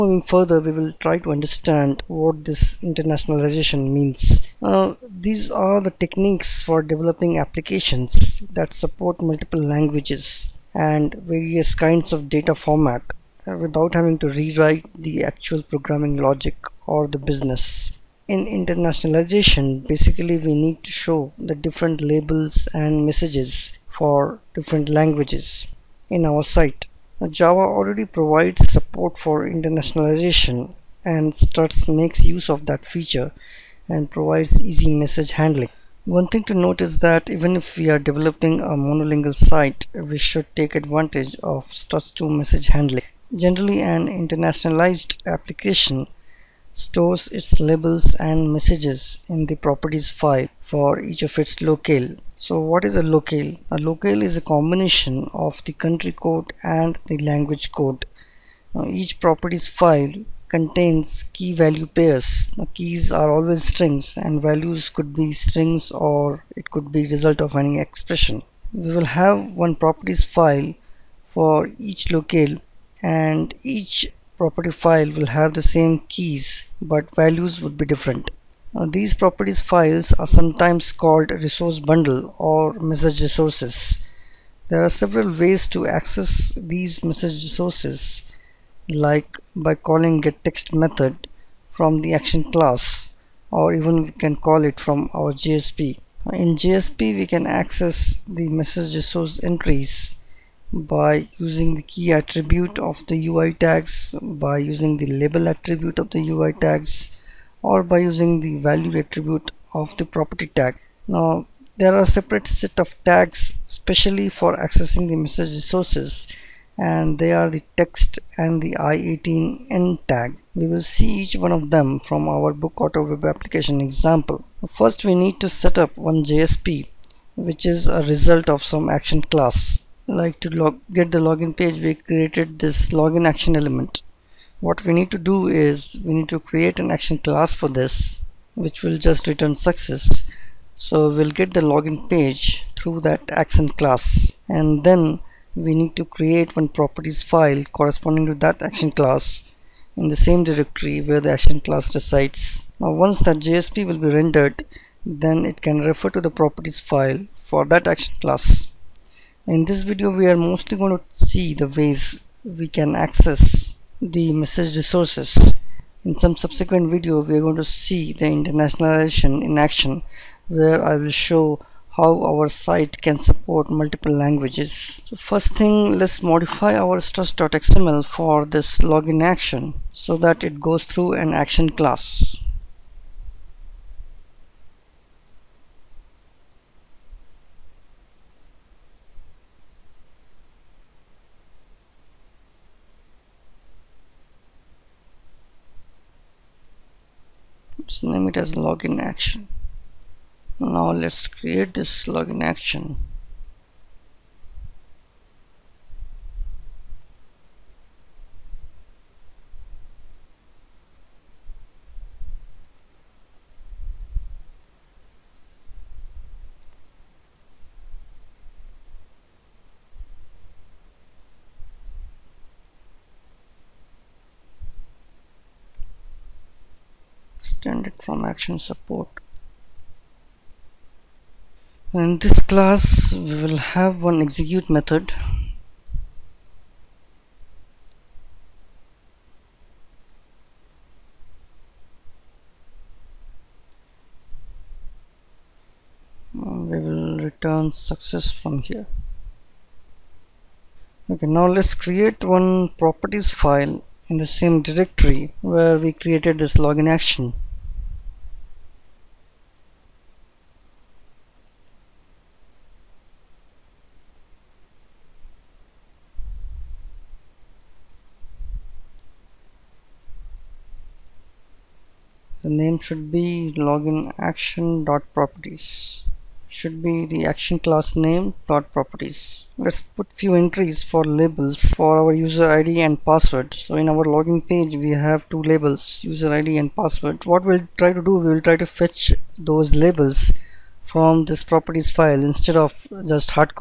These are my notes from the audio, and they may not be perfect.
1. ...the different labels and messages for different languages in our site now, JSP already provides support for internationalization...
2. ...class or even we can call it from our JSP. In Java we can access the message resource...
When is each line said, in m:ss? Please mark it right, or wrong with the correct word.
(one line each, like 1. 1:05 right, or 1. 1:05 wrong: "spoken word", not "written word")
1. 0:21 wrong: "Java", not "JSP"
2. 1:32 wrong: "JSP", not "Java".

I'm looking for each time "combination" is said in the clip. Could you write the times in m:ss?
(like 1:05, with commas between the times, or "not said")
0:54.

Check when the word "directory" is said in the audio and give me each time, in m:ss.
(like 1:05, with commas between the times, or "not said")
2:30, 4:14.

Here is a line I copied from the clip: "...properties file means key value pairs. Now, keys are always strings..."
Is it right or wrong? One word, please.
wrong.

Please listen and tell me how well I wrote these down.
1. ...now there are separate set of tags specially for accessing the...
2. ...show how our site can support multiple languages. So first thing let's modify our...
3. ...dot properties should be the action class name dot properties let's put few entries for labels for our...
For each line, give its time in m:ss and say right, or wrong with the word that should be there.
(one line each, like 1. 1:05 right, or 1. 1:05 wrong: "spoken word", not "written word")
1. 1:51 right
2. 2:51 right
3. 4:34 right.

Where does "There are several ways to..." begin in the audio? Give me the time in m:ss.
1:24.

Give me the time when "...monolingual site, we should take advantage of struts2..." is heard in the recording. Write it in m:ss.
0:38.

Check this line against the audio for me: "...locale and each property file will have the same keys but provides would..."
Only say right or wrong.
wrong.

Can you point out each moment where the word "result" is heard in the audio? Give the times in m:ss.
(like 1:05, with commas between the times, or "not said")
1:07, 2:08.